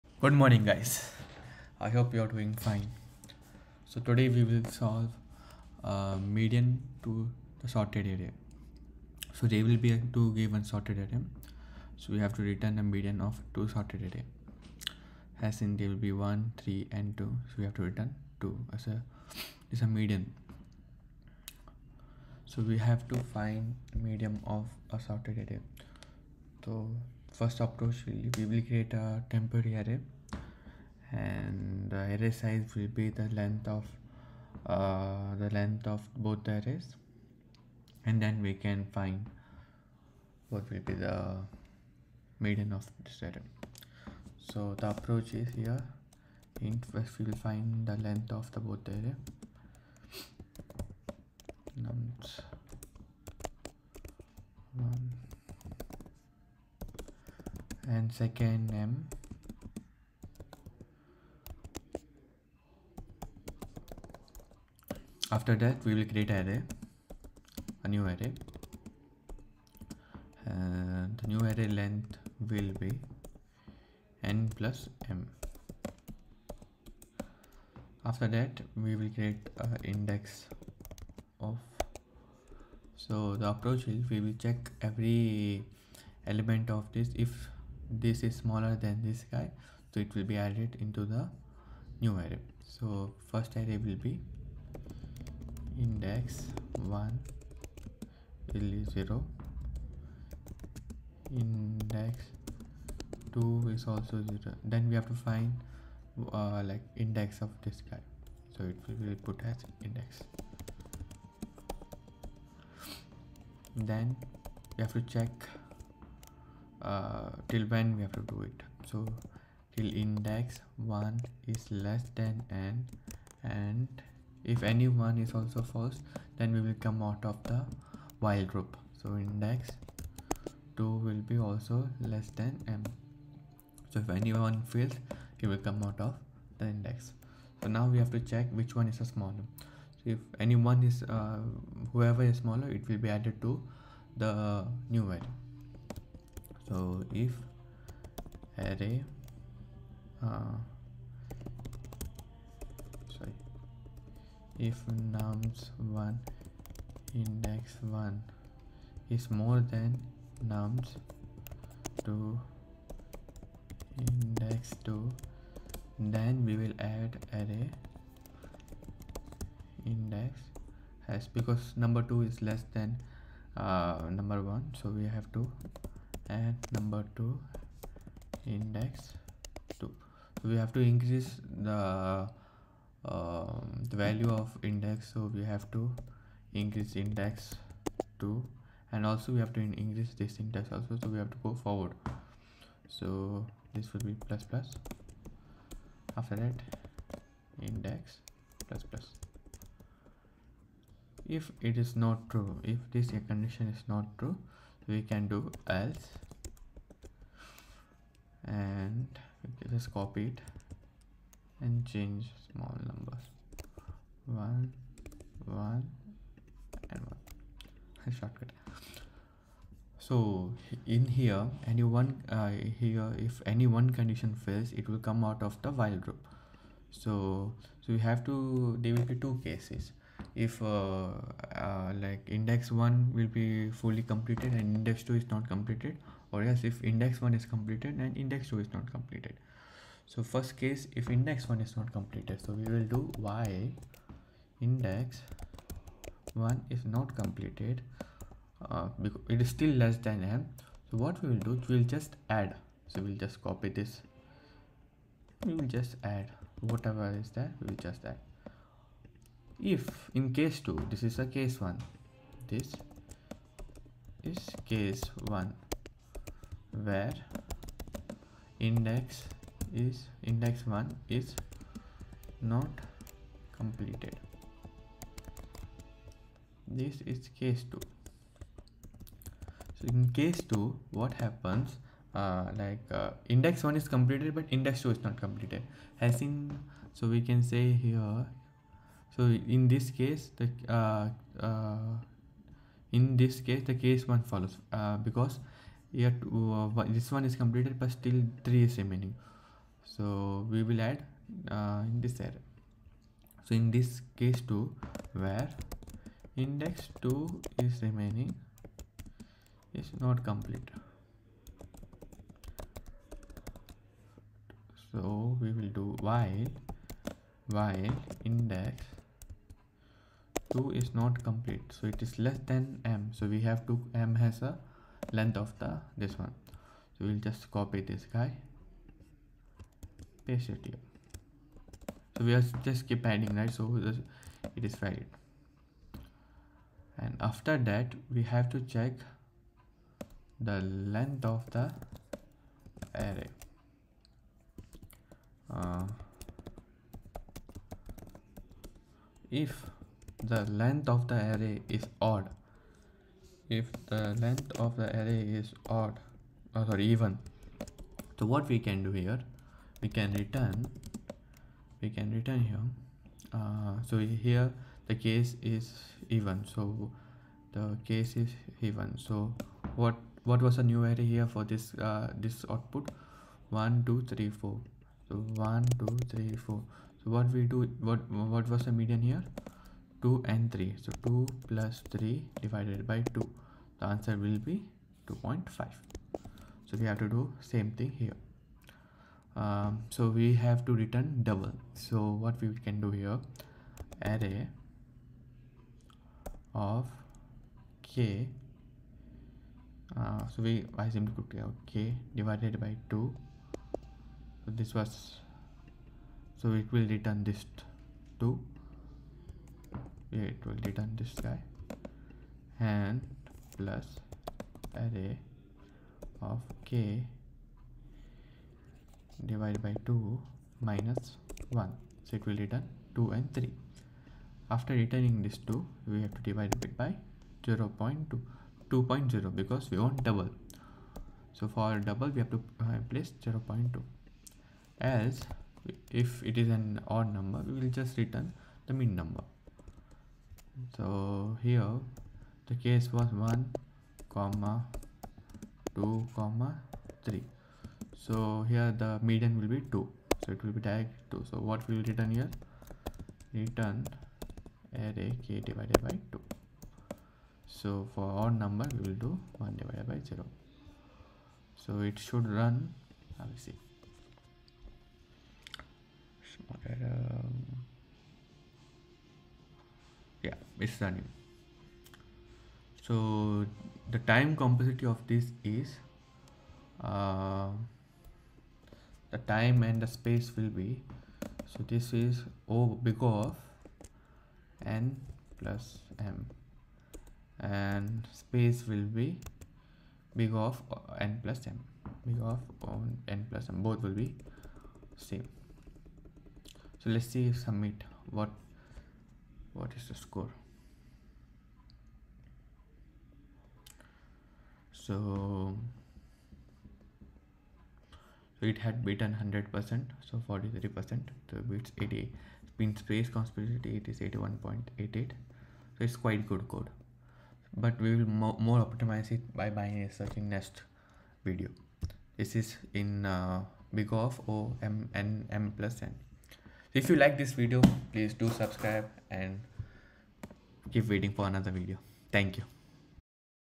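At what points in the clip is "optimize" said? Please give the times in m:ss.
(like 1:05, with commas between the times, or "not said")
8:38.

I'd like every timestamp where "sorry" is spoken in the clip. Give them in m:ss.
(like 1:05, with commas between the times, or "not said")
5:56.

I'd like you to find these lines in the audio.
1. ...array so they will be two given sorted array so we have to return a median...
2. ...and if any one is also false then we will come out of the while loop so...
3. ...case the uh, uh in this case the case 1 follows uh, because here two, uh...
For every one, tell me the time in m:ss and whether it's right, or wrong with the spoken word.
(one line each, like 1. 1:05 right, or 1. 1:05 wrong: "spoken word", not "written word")
1. 0:08 right
2. 2:03 right
3. 4:49 right.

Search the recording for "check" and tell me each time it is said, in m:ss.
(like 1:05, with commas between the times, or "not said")
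1:24, 1:55, 2:18, 5:38.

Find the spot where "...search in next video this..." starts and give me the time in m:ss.
8:39.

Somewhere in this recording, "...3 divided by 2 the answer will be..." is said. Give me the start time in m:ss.
6:21.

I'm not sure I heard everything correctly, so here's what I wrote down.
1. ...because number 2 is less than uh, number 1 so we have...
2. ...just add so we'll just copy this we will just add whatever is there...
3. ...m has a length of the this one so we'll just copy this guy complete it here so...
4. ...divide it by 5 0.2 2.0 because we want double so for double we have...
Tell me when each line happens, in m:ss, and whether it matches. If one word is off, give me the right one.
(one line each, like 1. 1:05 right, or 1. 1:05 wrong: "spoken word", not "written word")
1. 2:51 right
2. 4:11 right
3. 5:23 wrong: "paste", not "complete"
4. 7:06 wrong: "0", not "5".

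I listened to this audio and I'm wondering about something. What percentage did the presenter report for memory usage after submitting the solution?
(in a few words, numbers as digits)
81.88.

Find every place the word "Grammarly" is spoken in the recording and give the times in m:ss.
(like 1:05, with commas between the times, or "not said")
not said.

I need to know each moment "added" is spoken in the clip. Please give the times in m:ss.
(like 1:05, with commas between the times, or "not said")
1:30, 2:23.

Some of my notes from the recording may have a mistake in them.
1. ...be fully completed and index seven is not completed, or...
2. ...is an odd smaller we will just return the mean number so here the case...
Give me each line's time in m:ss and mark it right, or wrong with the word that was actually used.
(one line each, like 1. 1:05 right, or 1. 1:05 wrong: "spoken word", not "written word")
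1. 3:53 wrong: "two", not "seven"
2. 7:16 wrong: "number", not "smaller".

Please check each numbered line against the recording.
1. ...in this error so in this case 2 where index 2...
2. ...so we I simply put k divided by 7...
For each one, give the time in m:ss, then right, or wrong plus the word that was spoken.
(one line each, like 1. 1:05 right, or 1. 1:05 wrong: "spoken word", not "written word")
1. 5:01 right
2. 6:40 wrong: "2", not "7".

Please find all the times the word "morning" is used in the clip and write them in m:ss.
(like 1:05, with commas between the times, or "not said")
0:00.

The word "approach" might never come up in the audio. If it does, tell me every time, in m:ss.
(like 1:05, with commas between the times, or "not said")
0:27, 0:44, 1:23.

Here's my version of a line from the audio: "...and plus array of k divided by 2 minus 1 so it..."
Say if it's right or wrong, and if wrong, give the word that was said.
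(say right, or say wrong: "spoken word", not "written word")
right.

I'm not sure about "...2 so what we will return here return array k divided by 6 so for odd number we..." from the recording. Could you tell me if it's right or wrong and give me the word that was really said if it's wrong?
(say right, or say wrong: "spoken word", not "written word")
wrong: "2", not "6".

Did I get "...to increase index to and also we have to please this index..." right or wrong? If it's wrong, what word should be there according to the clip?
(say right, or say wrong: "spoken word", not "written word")
wrong: "increase", not "please".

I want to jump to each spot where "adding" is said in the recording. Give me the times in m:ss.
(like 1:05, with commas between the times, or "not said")
5:33.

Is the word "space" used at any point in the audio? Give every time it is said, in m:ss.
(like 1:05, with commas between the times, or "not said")
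7:59, 8:08, 8:32.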